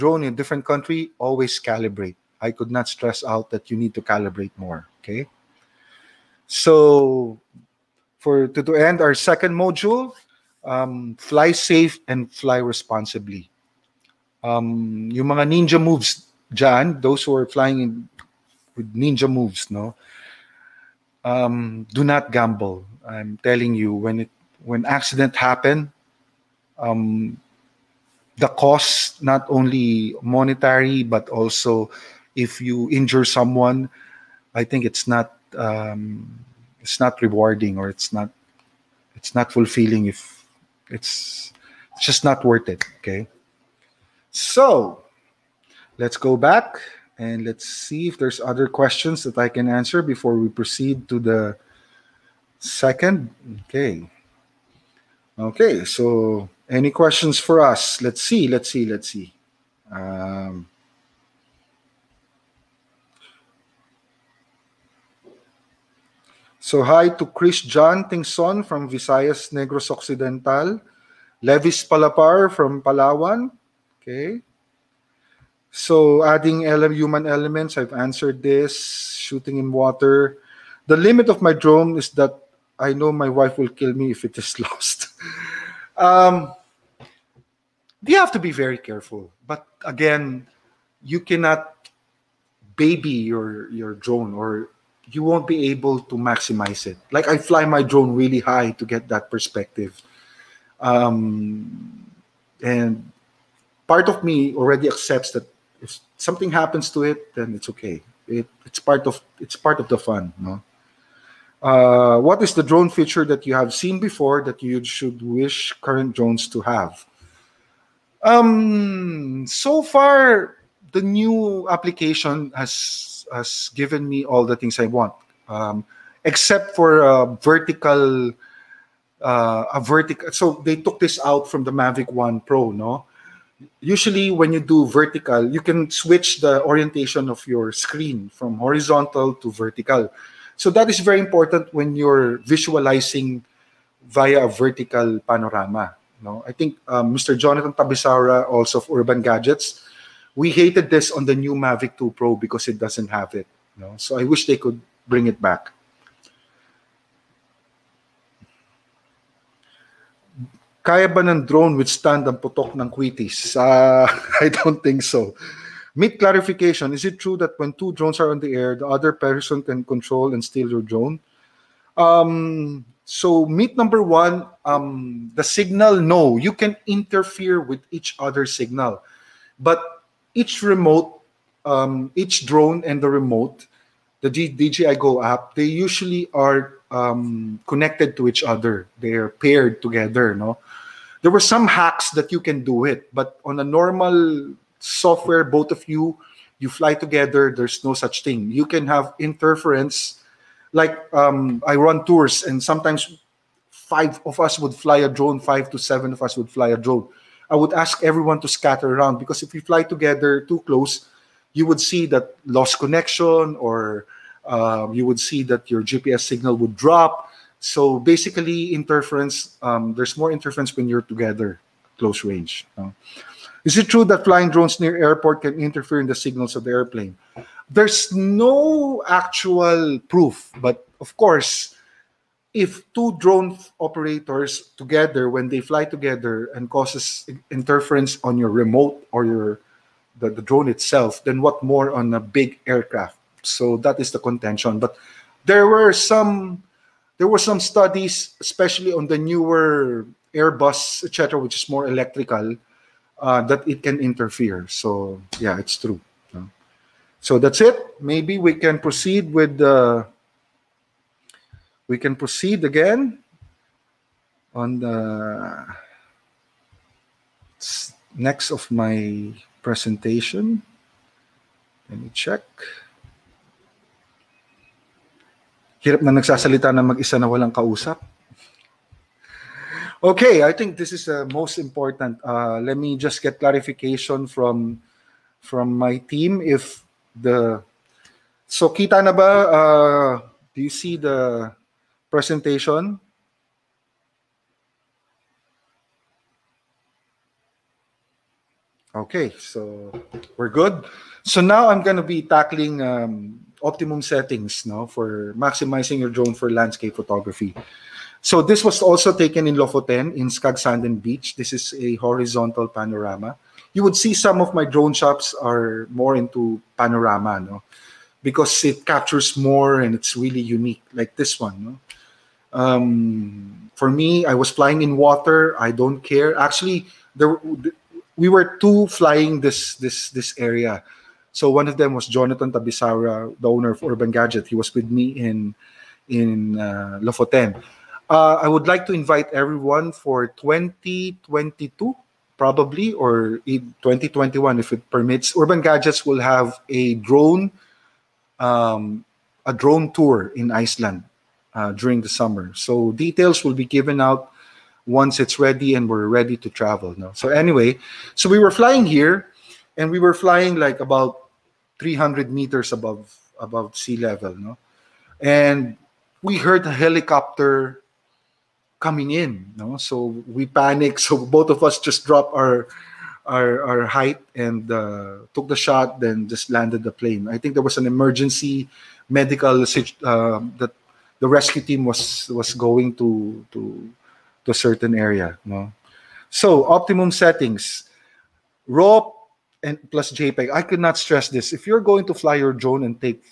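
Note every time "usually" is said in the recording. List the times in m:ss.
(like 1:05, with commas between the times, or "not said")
2:13, 3:05.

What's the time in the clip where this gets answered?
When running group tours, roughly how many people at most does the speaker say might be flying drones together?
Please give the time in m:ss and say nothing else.
3:25.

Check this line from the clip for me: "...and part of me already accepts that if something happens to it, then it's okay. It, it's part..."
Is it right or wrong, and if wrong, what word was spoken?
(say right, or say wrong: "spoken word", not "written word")
right.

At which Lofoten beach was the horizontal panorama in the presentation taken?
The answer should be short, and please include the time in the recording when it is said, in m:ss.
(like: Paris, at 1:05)
Skagsanden Beach, at 5:10.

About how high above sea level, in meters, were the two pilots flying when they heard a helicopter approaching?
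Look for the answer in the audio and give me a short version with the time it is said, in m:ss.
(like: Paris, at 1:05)
300, at 6:01.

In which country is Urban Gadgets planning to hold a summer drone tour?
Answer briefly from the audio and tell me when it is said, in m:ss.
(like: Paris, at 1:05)
Iceland, at 5:50.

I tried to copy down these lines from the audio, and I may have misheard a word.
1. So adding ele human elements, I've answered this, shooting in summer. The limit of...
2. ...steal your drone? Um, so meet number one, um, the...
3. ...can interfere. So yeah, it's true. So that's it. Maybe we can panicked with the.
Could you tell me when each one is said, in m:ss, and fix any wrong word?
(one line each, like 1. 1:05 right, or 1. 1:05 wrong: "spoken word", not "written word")
1. 1:15 wrong: "water", not "summer"
2. 2:50 right
3. 4:13 wrong: "proceed", not "panicked".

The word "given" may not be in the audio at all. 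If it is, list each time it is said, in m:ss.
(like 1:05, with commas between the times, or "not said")
2:03, 5:53.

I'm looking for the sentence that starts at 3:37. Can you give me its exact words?
So basically, interference, um, there's more interference when you're together, close range.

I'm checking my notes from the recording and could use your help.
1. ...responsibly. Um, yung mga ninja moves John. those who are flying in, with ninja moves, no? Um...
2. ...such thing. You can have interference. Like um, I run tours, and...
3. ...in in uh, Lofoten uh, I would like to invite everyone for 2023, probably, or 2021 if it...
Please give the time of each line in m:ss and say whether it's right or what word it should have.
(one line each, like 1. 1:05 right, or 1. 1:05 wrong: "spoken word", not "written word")
1. 0:12 right
2. 3:17 right
3. 5:35 wrong: "2022", not "2023".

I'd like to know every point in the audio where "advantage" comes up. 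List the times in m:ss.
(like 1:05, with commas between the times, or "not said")
not said.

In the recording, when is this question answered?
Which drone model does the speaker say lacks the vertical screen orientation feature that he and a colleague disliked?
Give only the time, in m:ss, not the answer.
2:31.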